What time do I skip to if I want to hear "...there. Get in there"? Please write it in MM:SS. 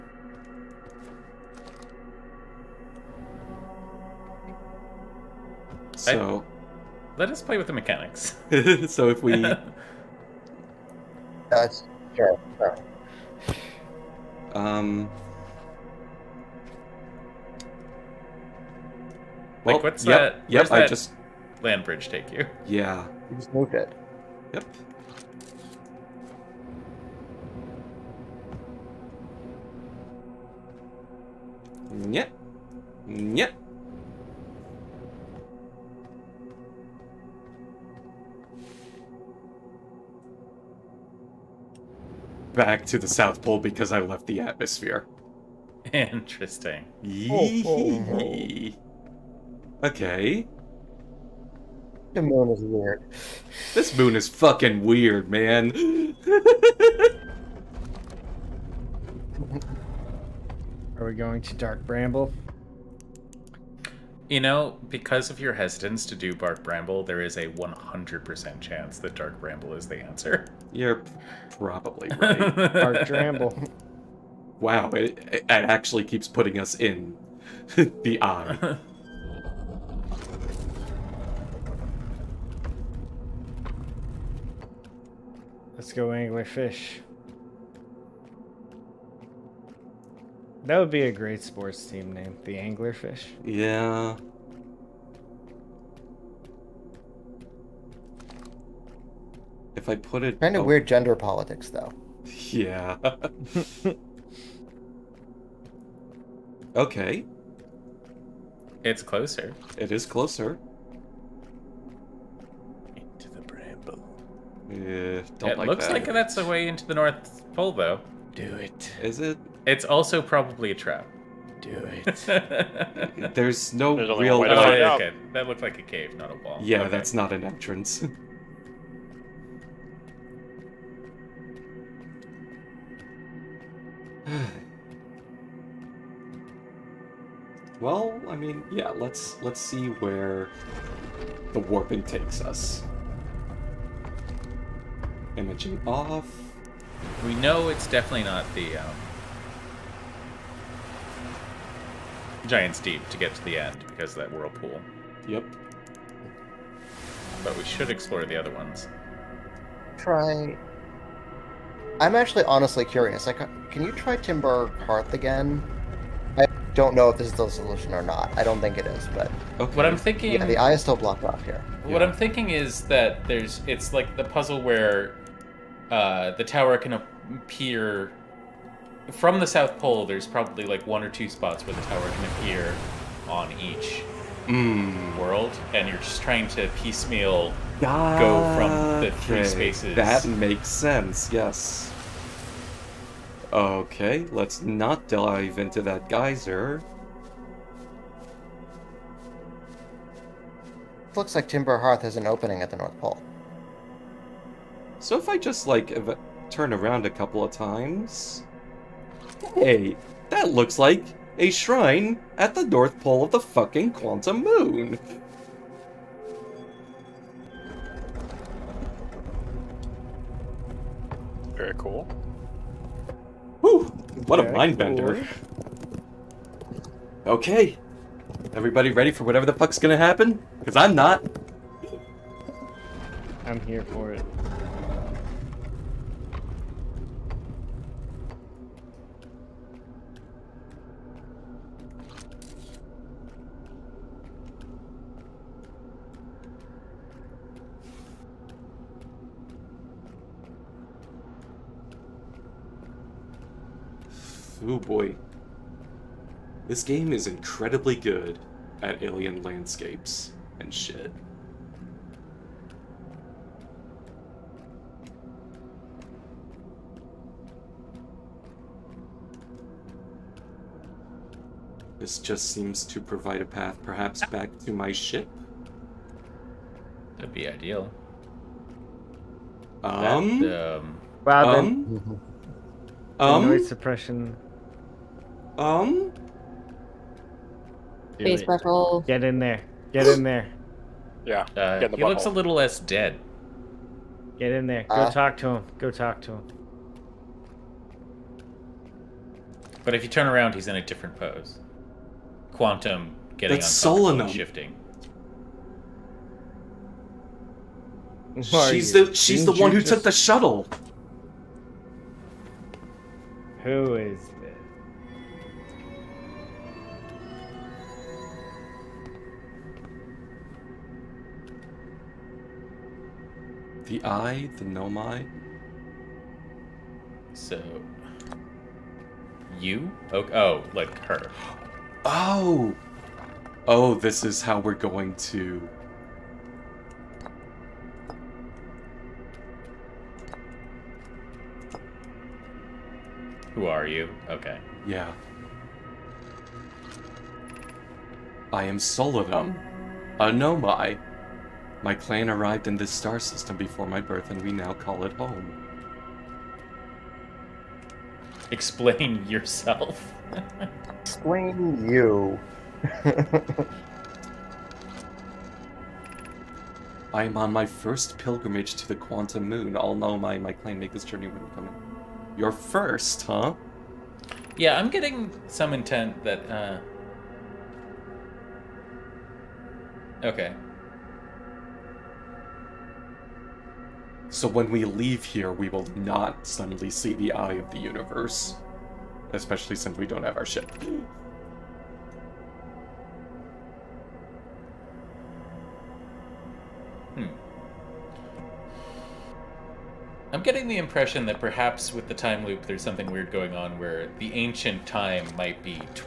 04:49.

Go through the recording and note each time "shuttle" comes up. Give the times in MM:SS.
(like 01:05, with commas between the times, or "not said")
05:10.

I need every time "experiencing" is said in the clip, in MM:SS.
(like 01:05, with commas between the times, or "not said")
not said.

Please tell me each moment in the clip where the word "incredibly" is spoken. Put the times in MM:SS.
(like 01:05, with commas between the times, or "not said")
04:17.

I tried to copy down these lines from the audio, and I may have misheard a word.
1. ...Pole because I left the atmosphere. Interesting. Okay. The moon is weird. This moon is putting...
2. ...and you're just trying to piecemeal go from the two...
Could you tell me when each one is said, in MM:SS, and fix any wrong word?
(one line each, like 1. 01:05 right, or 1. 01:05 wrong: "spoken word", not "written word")
1. 00:43 wrong: "fucking", not "putting"
2. 03:05 wrong: "three", not "two".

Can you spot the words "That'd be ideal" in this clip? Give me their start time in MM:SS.
04:37.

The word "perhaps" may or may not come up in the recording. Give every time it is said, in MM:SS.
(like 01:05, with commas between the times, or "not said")
04:33, 06:41.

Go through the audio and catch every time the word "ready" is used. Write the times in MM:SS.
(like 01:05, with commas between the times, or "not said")
03:48.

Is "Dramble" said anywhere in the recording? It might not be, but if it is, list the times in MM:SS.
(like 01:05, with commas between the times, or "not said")
01:13.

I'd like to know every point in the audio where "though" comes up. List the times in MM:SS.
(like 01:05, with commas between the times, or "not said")
01:41, 01:57.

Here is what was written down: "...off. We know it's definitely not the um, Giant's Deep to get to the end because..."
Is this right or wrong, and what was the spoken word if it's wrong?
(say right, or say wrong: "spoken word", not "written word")
right.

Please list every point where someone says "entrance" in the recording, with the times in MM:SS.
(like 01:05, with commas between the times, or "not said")
02:07.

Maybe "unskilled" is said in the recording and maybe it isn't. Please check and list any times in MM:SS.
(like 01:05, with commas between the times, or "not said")
not said.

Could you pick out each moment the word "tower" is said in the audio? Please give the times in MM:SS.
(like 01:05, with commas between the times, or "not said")
02:56, 03:01.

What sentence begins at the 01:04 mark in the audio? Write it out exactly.
You know, because of your hesitance to do Dark Bramble, there is a 100% chance that Dark Bramble is the answer.